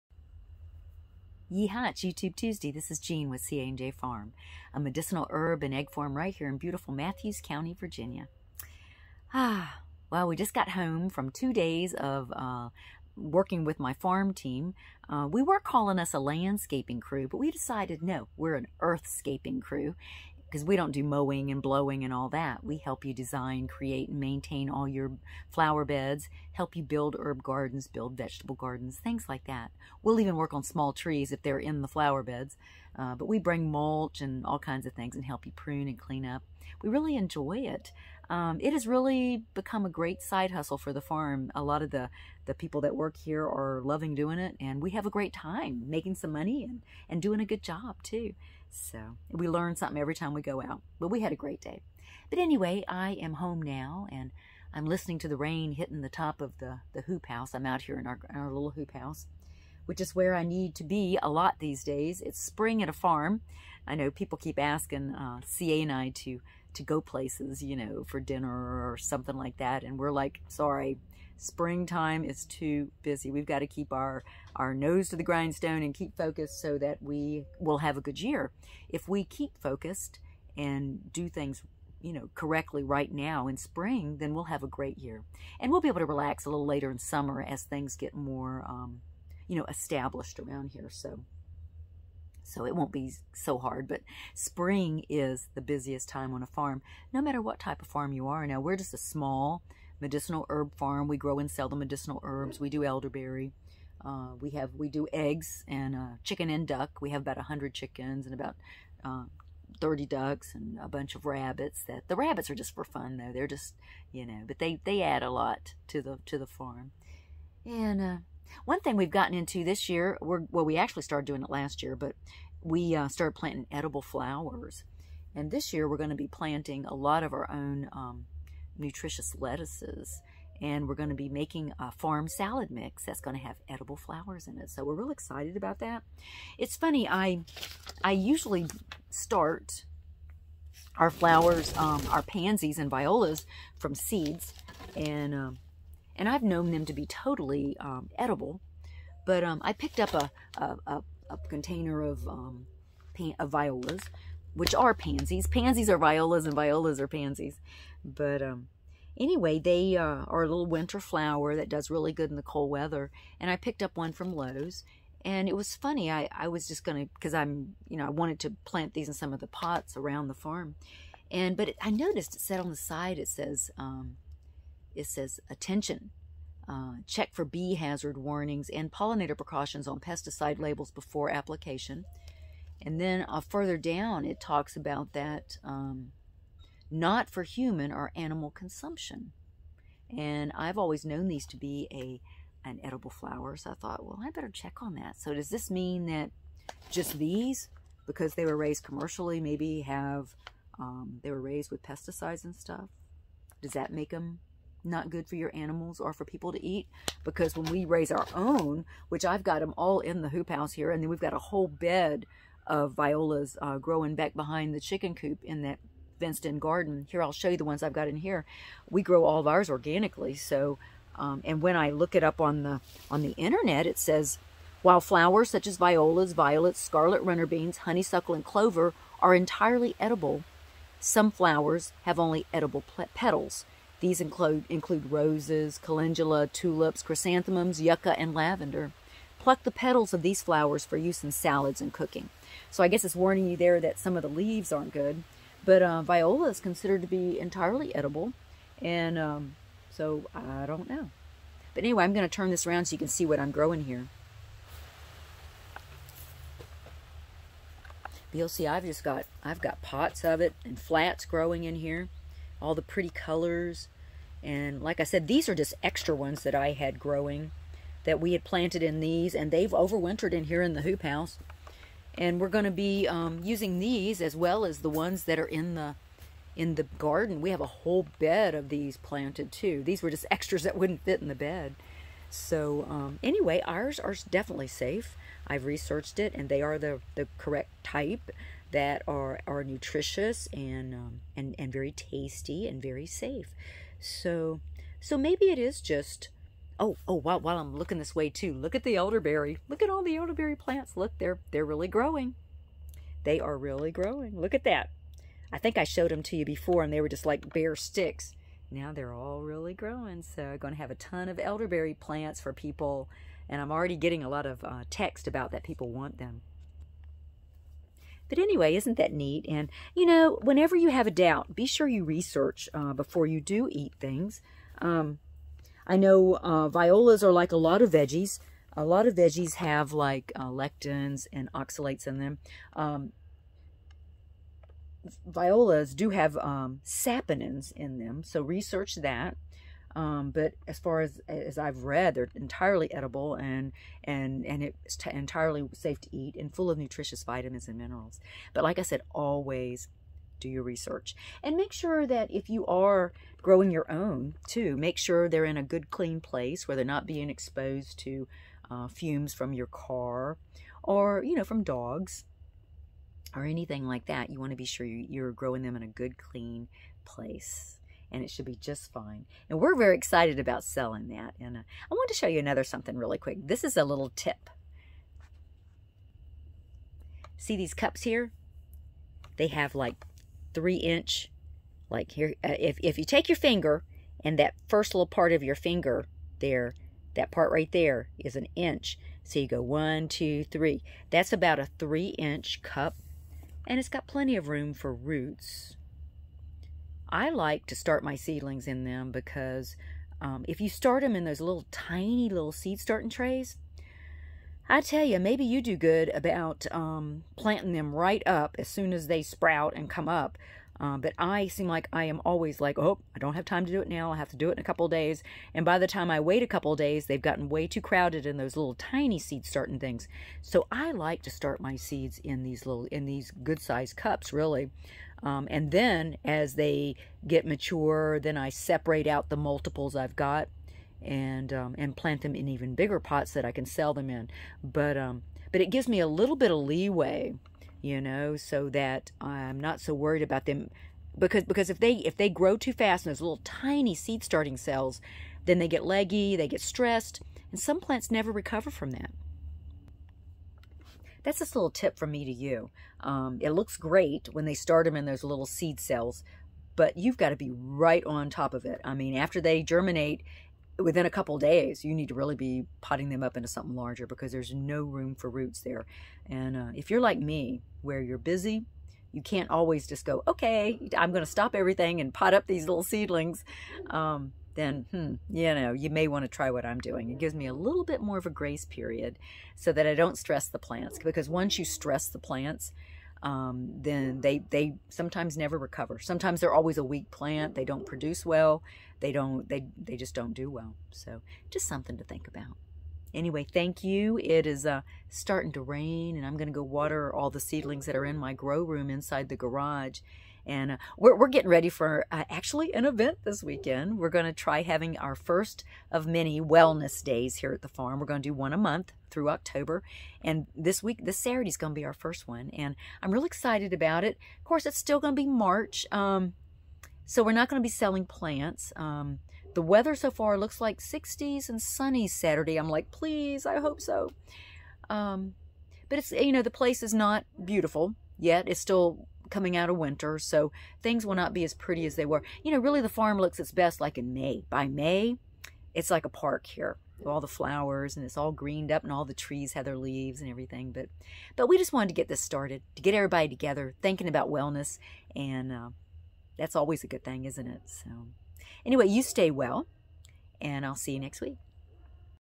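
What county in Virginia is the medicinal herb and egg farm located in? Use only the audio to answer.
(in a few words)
Mathews County.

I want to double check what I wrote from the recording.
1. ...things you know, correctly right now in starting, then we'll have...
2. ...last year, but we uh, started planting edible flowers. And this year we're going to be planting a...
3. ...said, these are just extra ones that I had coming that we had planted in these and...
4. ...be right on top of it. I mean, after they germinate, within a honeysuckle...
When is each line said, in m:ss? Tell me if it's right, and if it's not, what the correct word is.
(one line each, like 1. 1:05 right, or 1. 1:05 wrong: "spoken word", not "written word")
1. 1:21 wrong: "spring", not "starting"
2. 2:01 right
3. 4:25 wrong: "growing", not "coming"
4. 7:37 wrong: "couple", not "honeysuckle".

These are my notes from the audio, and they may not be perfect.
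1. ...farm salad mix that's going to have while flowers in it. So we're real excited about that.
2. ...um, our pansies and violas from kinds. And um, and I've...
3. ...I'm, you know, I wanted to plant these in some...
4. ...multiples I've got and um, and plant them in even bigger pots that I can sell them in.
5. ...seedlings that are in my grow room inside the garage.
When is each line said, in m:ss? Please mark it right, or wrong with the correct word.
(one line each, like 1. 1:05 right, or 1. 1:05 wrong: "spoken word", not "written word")
1. 2:11 wrong: "edible", not "while"
2. 2:21 wrong: "seeds", not "kinds"
3. 2:47 right
4. 7:09 right
5. 8:17 right.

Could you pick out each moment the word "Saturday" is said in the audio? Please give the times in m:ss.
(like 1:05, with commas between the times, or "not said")
8:31, 8:42.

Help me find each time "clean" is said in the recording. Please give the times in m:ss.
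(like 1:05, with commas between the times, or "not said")
0:35, 5:55, 6:06.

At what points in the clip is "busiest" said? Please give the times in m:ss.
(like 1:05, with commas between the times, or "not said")
1:35.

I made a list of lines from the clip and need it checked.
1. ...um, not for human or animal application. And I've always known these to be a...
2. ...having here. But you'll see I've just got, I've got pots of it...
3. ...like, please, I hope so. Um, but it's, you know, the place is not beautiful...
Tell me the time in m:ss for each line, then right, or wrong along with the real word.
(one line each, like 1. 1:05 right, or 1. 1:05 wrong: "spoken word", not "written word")
1. 3:05 wrong: "consumption", not "application"
2. 4:13 wrong: "growing", not "having"
3. 8:42 right.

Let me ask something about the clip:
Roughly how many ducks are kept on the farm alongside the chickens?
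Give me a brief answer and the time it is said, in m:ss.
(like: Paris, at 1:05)
30, at 1:49.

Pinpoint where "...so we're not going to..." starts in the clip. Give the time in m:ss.
8:37.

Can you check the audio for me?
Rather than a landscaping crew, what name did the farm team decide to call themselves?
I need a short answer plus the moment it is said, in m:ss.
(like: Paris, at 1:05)
earthscaping crew, at 0:18.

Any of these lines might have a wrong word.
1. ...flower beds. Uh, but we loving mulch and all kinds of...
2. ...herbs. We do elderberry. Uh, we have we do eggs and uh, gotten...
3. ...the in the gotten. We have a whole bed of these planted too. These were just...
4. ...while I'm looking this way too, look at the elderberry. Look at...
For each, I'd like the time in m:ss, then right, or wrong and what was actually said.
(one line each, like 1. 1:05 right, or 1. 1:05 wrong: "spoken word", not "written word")
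1. 0:31 wrong: "bring", not "loving"
2. 1:42 wrong: "chicken", not "gotten"
3. 4:35 wrong: "garden", not "gotten"
4. 4:57 right.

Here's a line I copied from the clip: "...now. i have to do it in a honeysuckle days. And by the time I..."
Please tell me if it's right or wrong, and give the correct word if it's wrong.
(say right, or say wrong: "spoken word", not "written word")
wrong: "couple", not "honeysuckle".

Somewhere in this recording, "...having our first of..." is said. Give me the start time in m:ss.
8:24.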